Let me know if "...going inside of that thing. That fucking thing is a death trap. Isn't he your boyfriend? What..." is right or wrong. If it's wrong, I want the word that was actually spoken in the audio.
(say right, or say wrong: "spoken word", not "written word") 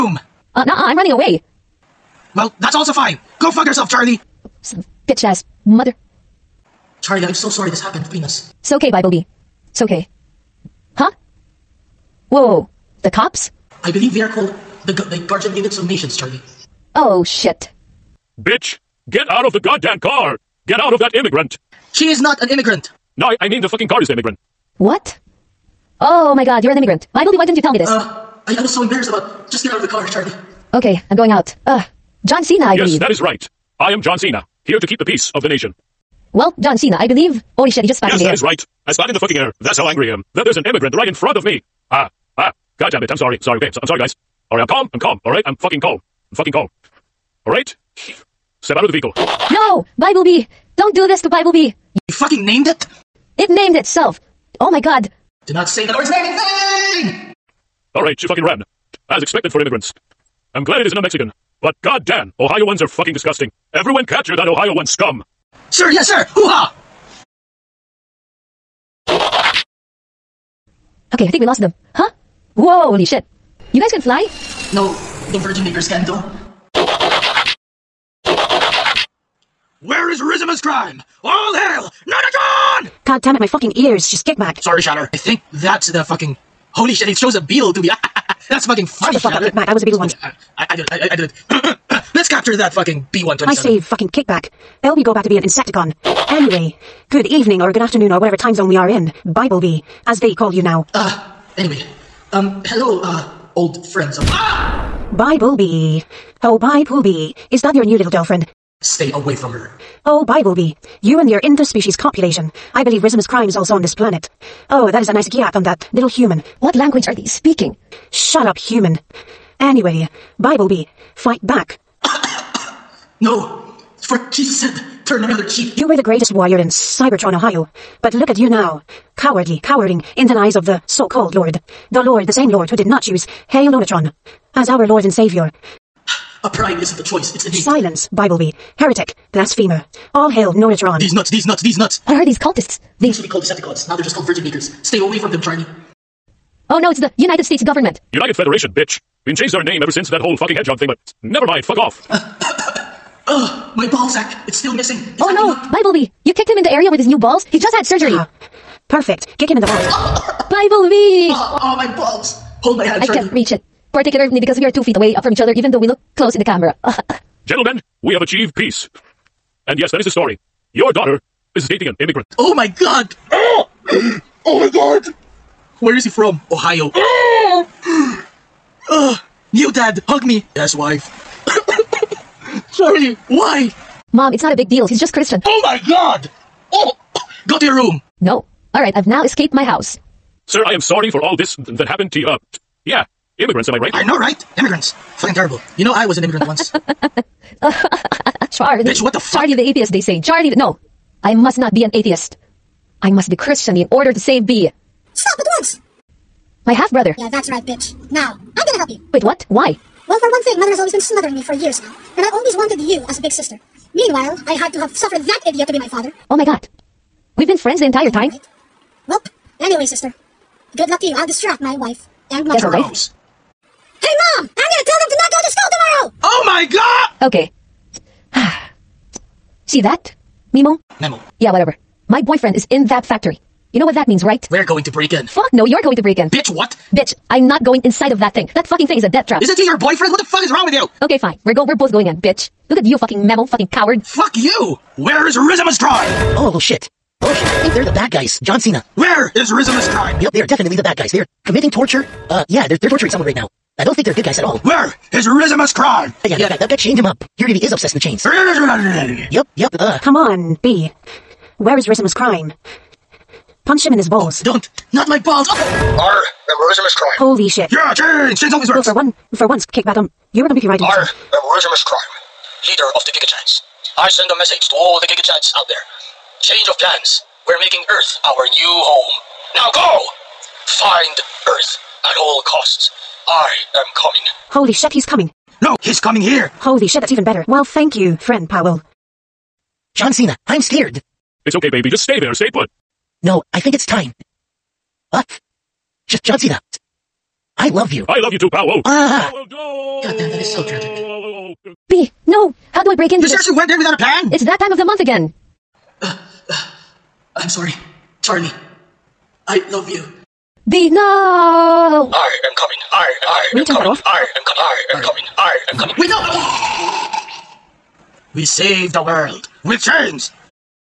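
right.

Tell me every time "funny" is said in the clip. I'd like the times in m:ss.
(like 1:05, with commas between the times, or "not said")
1:28.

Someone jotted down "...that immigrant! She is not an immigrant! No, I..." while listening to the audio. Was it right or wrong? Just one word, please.
right.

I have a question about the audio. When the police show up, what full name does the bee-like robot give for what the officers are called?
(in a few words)
Guardian Units of Nations.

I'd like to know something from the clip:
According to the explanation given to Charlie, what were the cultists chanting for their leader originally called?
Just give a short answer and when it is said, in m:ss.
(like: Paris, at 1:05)
Decepticons, at 2:23.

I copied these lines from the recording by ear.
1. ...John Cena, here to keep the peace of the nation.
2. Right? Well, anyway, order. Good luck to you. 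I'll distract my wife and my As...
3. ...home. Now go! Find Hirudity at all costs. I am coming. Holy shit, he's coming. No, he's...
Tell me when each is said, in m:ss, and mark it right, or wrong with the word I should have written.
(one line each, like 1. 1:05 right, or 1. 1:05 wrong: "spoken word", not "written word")
1. 0:34 right
2. 3:38 wrong: "sister", not "order"
3. 4:38 wrong: "Earth", not "Hirudity".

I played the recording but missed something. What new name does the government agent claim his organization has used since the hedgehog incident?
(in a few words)
United Federation.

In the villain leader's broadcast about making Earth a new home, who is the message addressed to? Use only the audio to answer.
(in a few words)
GigaChads.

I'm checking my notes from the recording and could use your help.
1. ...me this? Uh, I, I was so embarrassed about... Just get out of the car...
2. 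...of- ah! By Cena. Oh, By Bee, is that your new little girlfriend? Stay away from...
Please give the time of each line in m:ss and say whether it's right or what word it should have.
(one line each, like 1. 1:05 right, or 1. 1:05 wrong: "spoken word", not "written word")
1. 0:27 right
2. 1:44 wrong: "Bee", not "Cena".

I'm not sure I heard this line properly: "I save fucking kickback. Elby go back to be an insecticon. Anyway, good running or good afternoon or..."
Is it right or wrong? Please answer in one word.
wrong.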